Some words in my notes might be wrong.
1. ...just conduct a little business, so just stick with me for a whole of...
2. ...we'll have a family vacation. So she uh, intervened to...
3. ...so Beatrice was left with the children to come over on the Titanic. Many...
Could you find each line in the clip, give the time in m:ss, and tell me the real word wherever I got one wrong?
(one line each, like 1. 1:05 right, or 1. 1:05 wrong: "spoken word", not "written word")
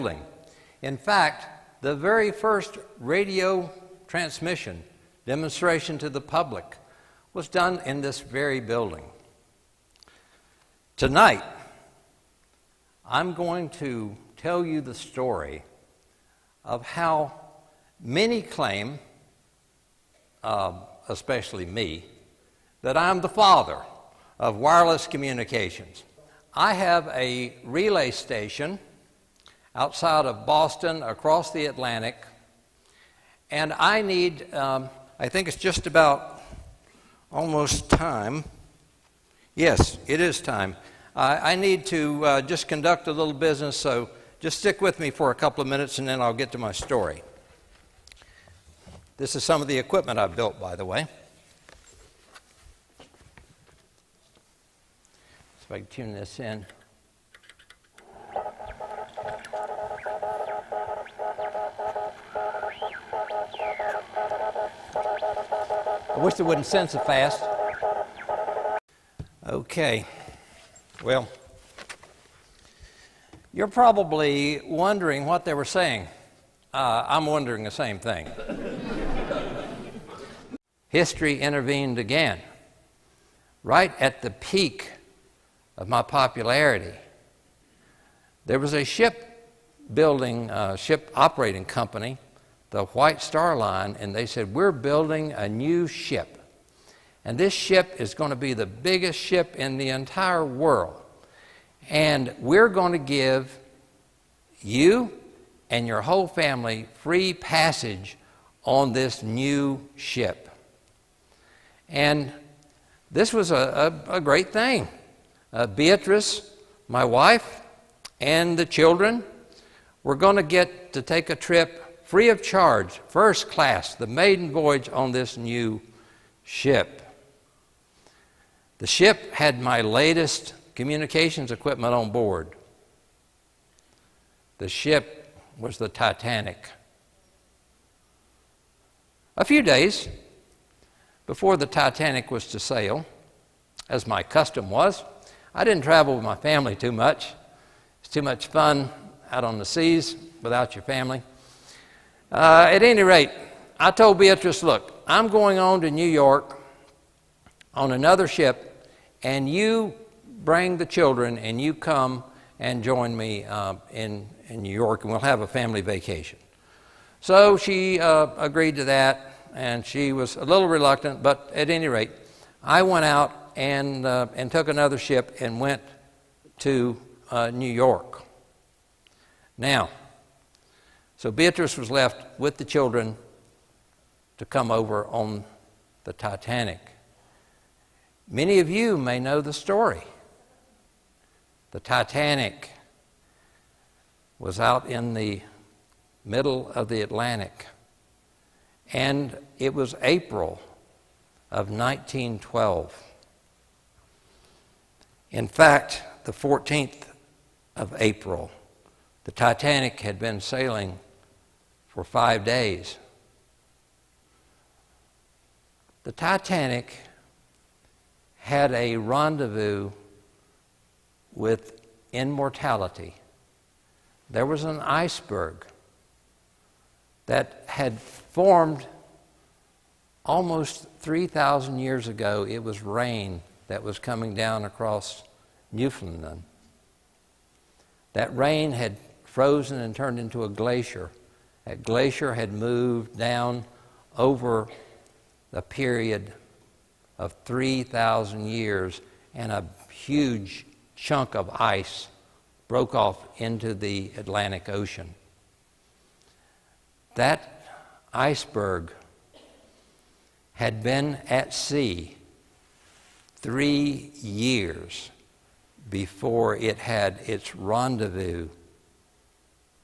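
1. 0:42 wrong: "couple", not "whole"
2. 2:45 wrong: "agreed", not "intervened"
3. 3:01 right.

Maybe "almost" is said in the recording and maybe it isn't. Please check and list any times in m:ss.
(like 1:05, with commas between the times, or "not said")
0:37, 3:50.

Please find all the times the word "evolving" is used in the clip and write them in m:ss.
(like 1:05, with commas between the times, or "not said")
not said.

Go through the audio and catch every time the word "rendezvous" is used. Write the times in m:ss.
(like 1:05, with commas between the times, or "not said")
3:38, 4:27.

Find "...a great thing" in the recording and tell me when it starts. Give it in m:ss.
1:54.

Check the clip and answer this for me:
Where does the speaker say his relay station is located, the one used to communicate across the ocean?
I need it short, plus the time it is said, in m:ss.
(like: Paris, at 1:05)
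Outside of Boston, at 0:29.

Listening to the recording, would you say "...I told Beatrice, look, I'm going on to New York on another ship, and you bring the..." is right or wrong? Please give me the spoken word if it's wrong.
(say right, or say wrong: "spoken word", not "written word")
right.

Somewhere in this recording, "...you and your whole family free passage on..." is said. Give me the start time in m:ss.
1:44.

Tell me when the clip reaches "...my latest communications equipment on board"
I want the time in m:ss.
2:09.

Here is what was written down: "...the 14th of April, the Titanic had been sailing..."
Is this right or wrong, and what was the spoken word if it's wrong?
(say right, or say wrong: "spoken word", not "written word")
right.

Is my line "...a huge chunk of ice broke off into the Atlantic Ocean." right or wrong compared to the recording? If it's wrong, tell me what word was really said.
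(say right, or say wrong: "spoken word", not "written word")
right.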